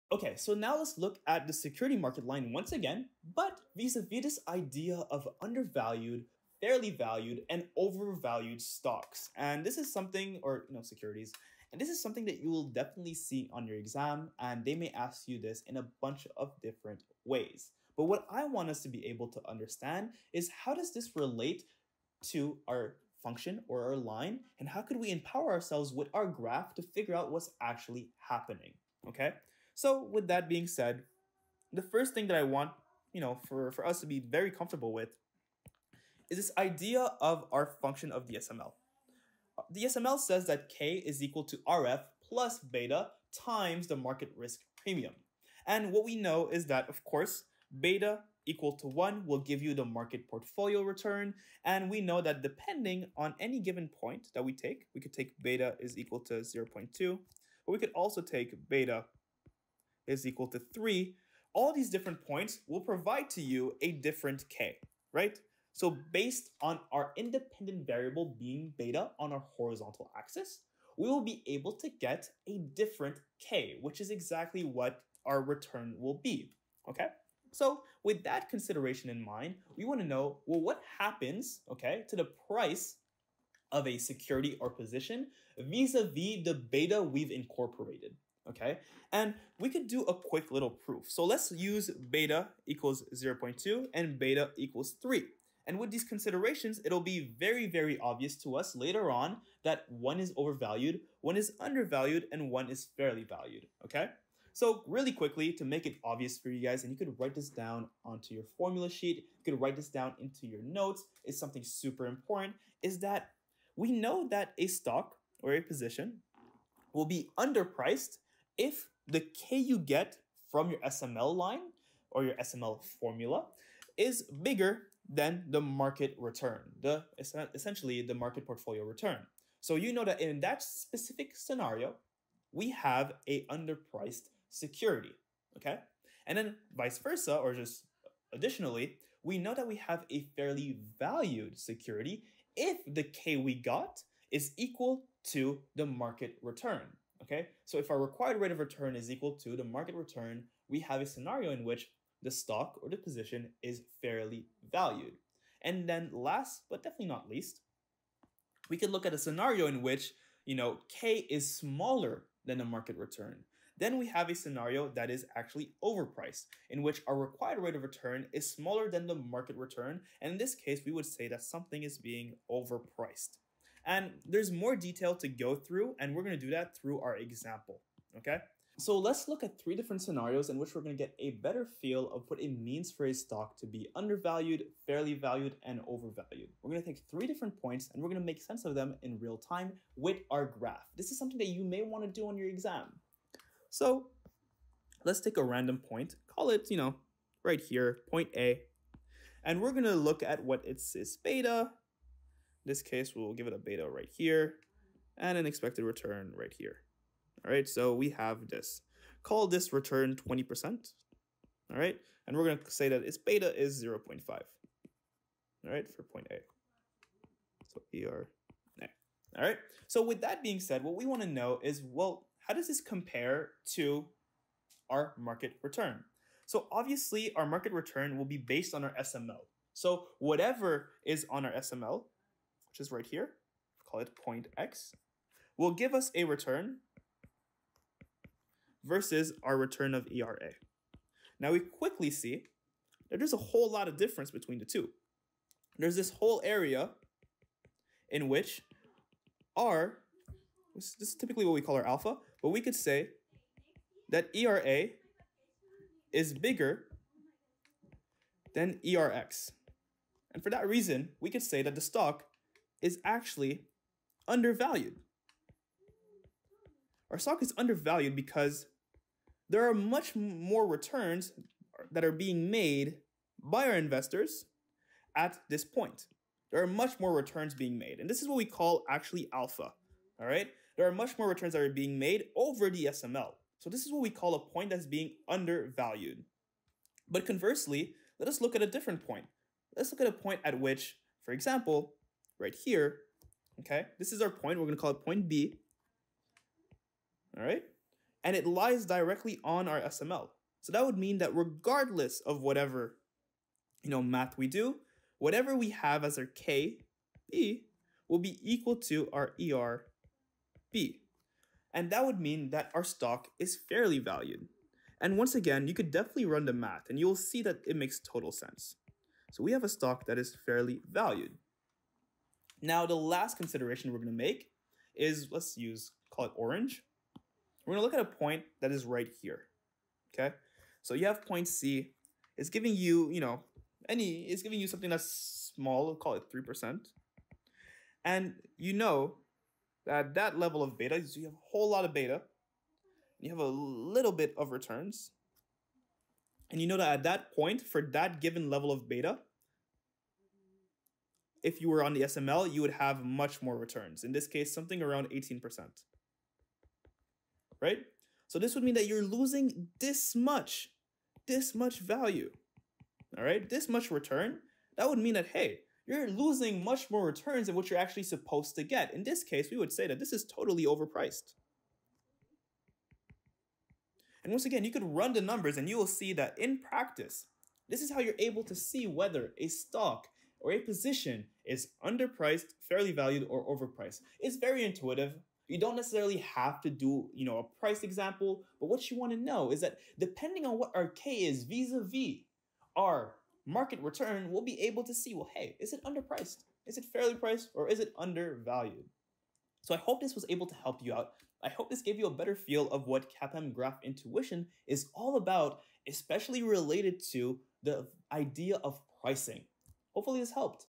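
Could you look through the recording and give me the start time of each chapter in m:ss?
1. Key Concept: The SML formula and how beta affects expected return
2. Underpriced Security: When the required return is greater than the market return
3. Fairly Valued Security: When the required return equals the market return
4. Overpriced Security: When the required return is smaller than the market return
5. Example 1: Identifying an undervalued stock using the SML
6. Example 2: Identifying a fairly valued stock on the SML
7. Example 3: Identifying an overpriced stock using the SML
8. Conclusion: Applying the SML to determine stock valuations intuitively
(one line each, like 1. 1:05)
1. 0:32
2. 1:44
3. 2:20
4. 2:54
5. 3:21
6. 4:42
7. 5:17
8. 6:27.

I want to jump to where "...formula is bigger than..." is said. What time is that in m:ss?
2:03.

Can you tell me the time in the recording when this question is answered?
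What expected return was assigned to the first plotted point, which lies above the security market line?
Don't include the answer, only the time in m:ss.
3:30.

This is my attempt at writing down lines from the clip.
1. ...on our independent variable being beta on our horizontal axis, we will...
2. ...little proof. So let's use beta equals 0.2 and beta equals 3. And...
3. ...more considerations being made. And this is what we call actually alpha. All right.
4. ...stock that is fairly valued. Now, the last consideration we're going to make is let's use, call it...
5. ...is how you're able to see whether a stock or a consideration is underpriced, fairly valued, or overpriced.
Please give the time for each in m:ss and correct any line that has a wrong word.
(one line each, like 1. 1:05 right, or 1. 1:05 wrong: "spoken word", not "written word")
1. 1:06 right
2. 1:30 right
3. 4:36 wrong: "returns", not "considerations"
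4. 5:19 right
5. 6:17 wrong: "position", not "consideration".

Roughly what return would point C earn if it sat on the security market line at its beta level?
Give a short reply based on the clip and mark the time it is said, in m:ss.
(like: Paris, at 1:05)
18%, at 5:55.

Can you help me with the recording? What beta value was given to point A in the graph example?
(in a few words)
0.5.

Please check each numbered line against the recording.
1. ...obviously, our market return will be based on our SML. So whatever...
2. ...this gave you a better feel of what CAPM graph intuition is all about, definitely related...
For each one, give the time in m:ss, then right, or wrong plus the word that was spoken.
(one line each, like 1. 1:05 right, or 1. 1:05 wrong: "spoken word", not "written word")
1. 3:46 right
2. 6:41 wrong: "especially", not "definitely".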